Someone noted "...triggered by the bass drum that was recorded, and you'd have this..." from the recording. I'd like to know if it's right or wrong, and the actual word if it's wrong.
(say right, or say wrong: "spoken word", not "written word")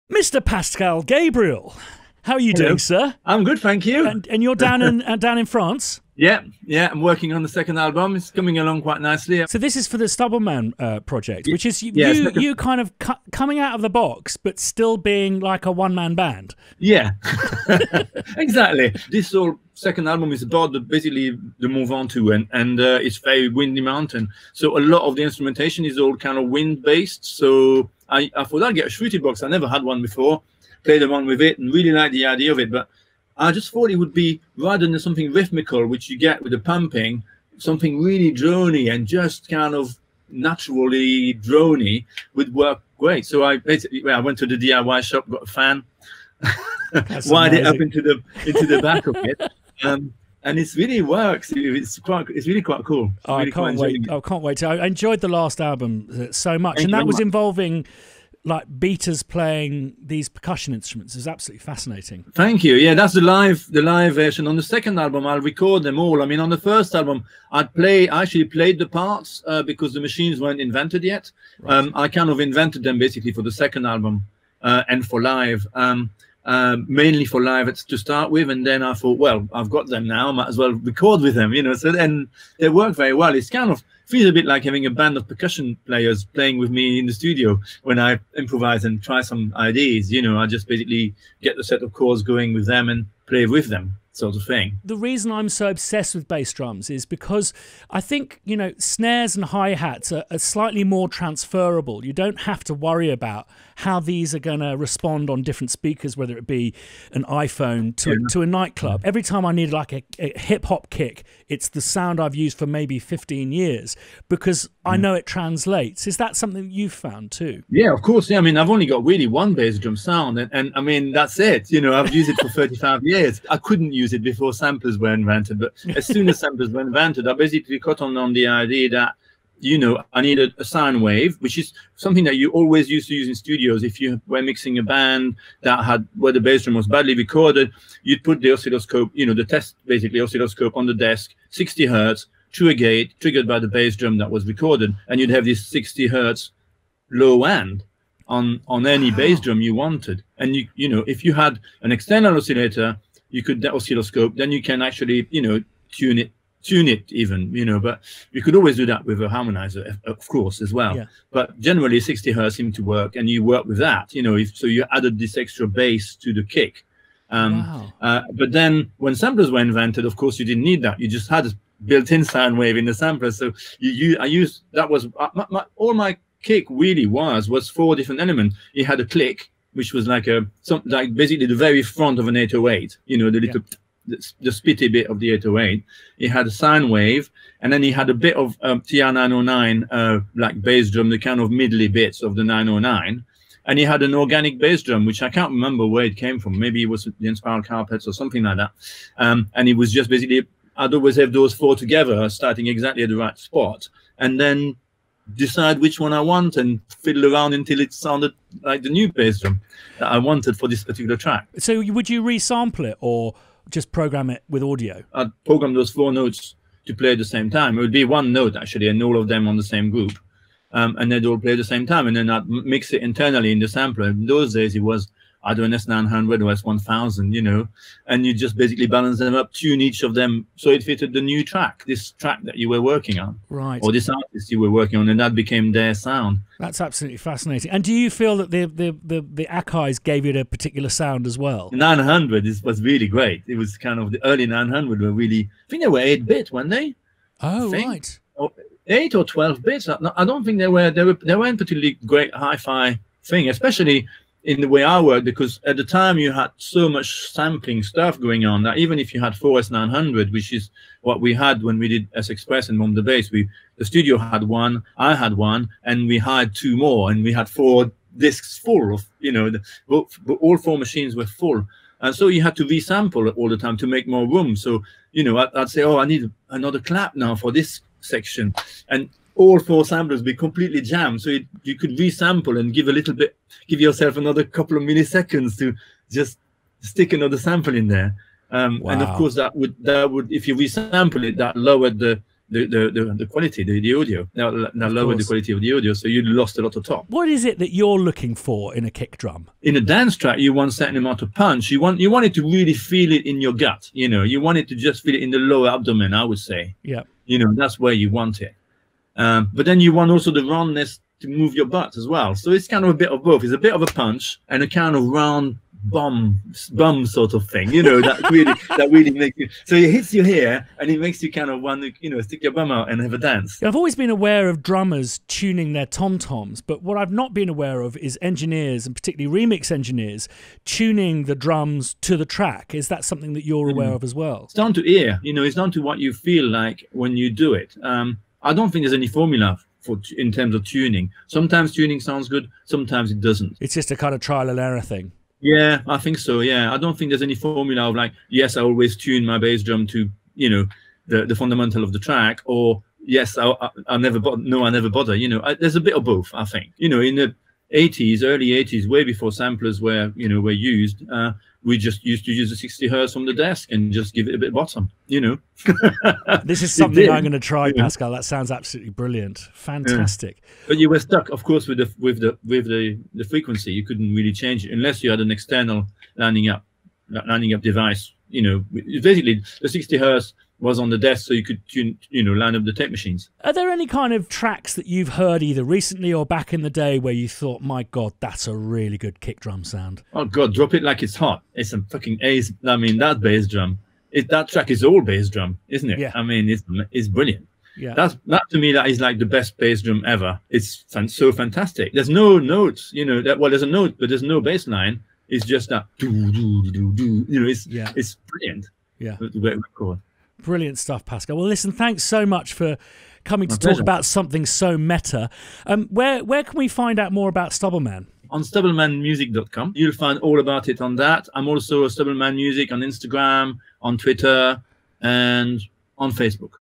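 right.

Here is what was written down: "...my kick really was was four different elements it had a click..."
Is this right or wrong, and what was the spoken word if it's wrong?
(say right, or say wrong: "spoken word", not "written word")
right.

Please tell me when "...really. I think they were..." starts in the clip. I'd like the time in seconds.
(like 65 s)
245 s.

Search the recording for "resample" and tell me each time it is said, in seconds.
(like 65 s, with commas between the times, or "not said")
212 s, 272 s, 281 s, 290 s.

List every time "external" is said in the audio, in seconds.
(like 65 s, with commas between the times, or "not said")
151 s, 375 s.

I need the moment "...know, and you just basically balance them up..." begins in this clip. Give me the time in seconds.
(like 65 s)
227 s.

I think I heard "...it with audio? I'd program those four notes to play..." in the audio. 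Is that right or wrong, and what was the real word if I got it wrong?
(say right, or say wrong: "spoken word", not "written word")
right.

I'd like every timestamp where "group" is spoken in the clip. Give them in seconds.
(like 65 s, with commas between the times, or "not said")
219 s.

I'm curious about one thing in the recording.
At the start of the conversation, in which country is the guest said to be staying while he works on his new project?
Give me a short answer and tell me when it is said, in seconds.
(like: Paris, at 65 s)
France, at 5 s.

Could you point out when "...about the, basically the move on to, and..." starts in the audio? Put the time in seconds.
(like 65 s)
20 s.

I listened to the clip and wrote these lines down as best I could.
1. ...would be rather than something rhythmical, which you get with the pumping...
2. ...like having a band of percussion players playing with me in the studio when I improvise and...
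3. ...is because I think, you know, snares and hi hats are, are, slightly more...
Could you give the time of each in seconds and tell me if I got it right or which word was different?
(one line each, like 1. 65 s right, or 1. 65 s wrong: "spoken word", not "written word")
1. 33 s right
2. 84 s right
3. 96 s right.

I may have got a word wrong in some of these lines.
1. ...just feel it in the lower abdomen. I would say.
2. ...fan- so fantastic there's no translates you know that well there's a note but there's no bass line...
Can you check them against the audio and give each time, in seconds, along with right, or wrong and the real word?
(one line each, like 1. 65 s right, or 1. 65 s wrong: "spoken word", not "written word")
1. 304 s right
2. 400 s wrong: "notes", not "translates".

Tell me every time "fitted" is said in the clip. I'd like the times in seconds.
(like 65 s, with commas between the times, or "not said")
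230 s.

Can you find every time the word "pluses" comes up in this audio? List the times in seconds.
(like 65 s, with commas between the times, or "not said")
not said.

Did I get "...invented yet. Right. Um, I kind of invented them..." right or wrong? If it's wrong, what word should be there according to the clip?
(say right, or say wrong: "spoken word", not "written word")
right.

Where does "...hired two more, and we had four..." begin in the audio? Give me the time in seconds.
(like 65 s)
266 s.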